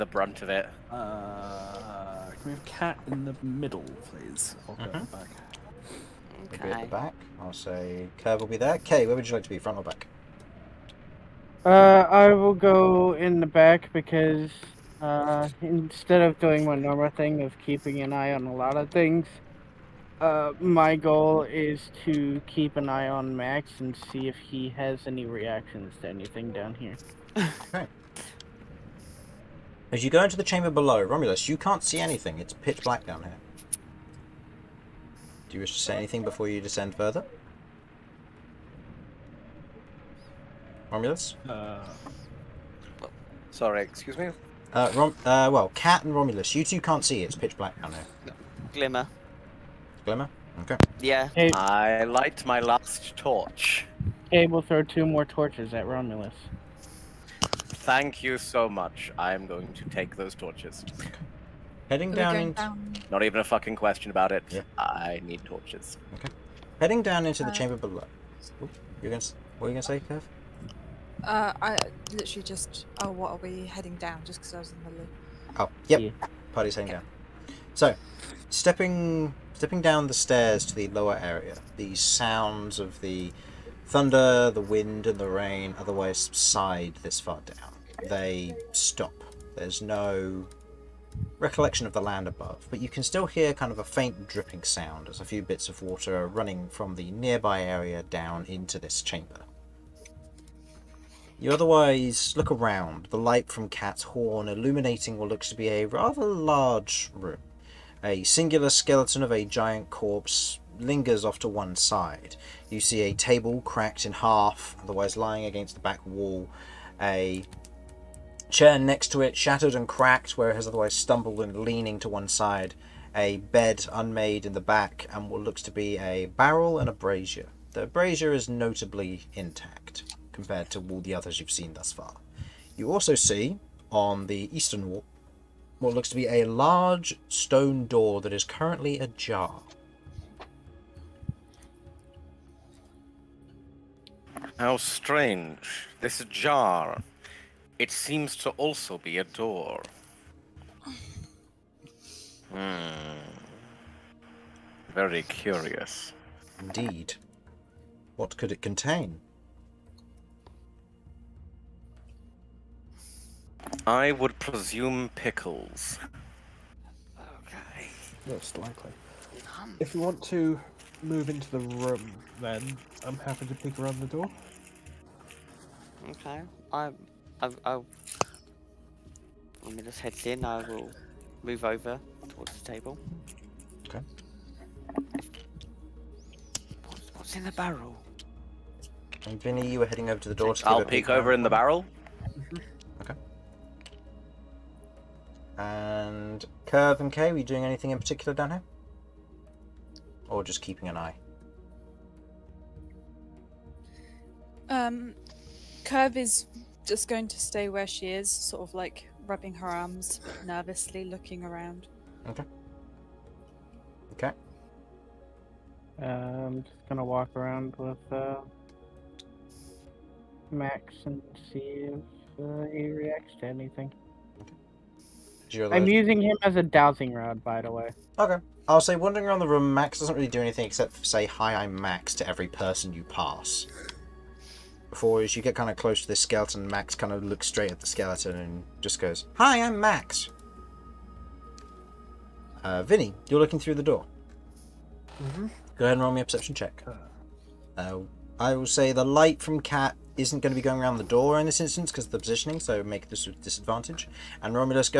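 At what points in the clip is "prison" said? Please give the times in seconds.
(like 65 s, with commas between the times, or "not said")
not said.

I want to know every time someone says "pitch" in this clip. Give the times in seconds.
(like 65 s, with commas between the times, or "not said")
32 s, 47 s.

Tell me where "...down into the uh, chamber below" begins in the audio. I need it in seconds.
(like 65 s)
67 s.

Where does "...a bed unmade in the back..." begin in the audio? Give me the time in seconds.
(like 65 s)
123 s.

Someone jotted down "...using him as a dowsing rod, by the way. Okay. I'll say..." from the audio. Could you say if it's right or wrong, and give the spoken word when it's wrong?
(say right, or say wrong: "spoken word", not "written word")
right.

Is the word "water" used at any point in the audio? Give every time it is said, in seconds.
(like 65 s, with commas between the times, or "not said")
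95 s.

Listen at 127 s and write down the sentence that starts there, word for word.
The brazier is notably intact compared to all the others you've seen thus far.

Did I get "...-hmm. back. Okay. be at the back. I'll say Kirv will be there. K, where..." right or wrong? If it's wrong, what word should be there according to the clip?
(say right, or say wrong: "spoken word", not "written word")
right.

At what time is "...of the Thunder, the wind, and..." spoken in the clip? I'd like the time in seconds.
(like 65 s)
82 s.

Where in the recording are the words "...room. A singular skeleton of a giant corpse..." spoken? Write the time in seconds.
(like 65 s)
107 s.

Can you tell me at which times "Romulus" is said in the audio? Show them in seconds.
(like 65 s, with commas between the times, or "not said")
31 s, 40 s, 46 s, 55 s.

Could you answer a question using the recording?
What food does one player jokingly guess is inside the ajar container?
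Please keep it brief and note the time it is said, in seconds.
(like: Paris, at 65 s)
pickles, at 165 s.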